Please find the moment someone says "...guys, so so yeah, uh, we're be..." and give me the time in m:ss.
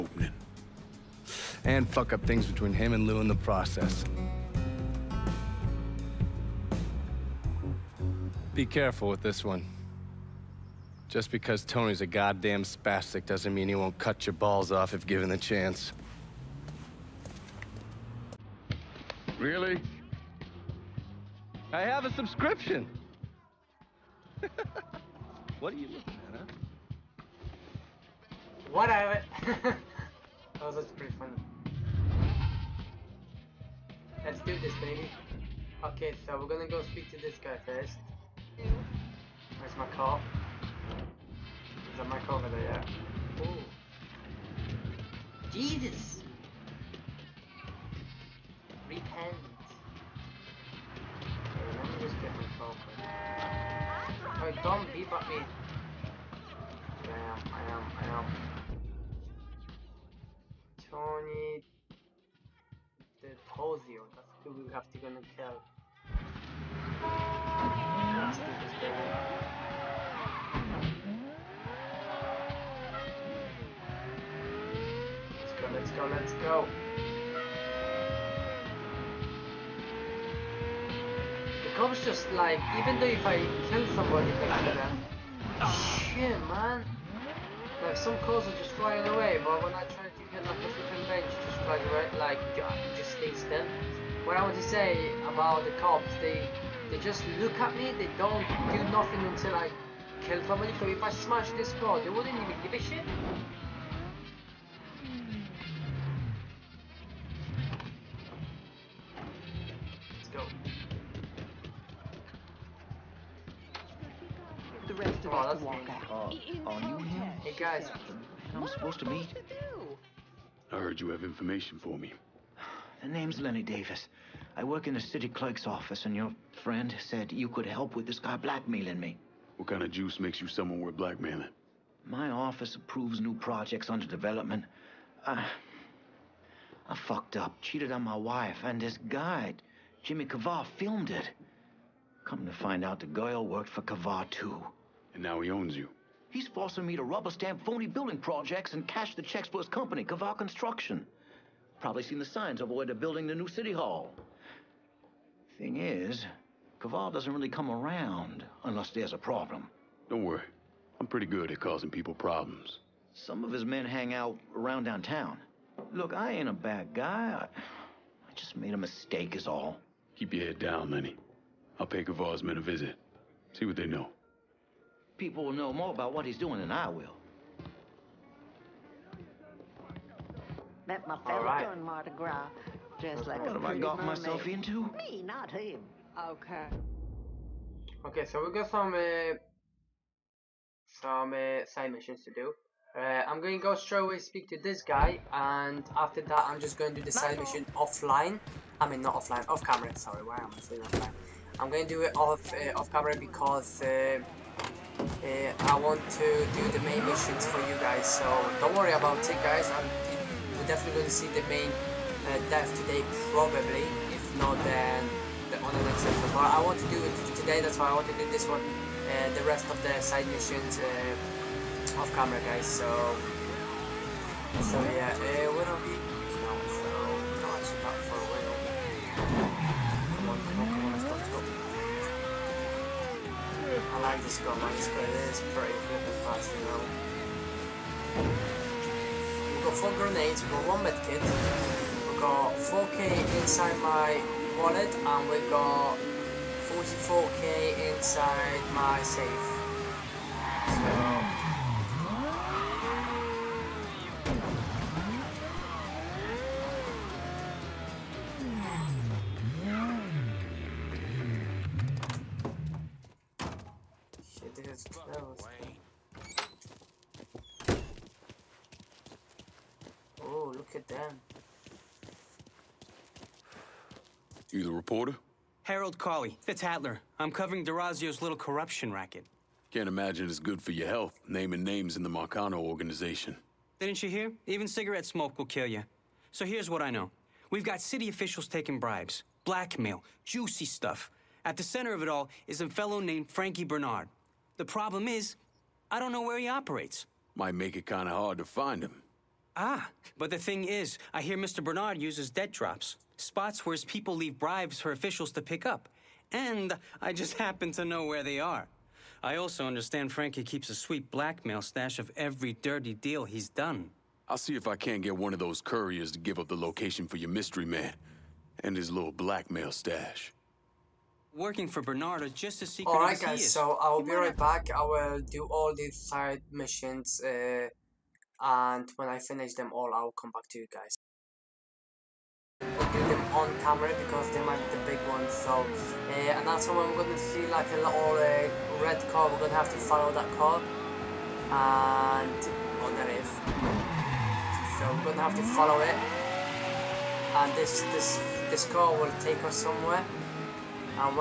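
3:42.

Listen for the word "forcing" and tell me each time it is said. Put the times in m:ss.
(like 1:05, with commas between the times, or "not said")
2:26.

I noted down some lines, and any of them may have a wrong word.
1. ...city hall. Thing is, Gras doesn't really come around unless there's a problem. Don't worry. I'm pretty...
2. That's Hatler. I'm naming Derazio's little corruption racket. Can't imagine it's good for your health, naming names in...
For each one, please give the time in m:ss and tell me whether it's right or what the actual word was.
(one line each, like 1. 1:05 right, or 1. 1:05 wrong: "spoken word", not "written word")
1. 2:33 wrong: "Kavar", not "Gras"
2. 4:36 wrong: "covering", not "naming".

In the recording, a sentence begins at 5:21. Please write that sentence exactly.
Working for Bernard is just as secret Alright guys, is.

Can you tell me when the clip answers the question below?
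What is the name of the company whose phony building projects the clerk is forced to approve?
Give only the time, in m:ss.
2:30.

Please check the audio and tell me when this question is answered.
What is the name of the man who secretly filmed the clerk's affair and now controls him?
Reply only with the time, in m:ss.
2:20.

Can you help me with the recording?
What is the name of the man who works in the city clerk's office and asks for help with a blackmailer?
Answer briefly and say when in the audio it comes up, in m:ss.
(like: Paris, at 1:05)
Lenny Davis, at 2:03.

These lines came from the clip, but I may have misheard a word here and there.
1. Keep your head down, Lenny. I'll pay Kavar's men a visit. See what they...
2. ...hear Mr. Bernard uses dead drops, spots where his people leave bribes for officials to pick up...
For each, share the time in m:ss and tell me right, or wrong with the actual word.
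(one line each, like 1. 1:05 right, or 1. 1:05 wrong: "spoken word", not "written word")
1. 2:50 right
2. 5:01 right.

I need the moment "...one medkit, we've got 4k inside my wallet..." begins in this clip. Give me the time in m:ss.
4:00.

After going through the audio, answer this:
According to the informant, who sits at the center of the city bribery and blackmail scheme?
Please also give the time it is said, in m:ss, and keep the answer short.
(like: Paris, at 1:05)
Frankie Bernard, at 4:53.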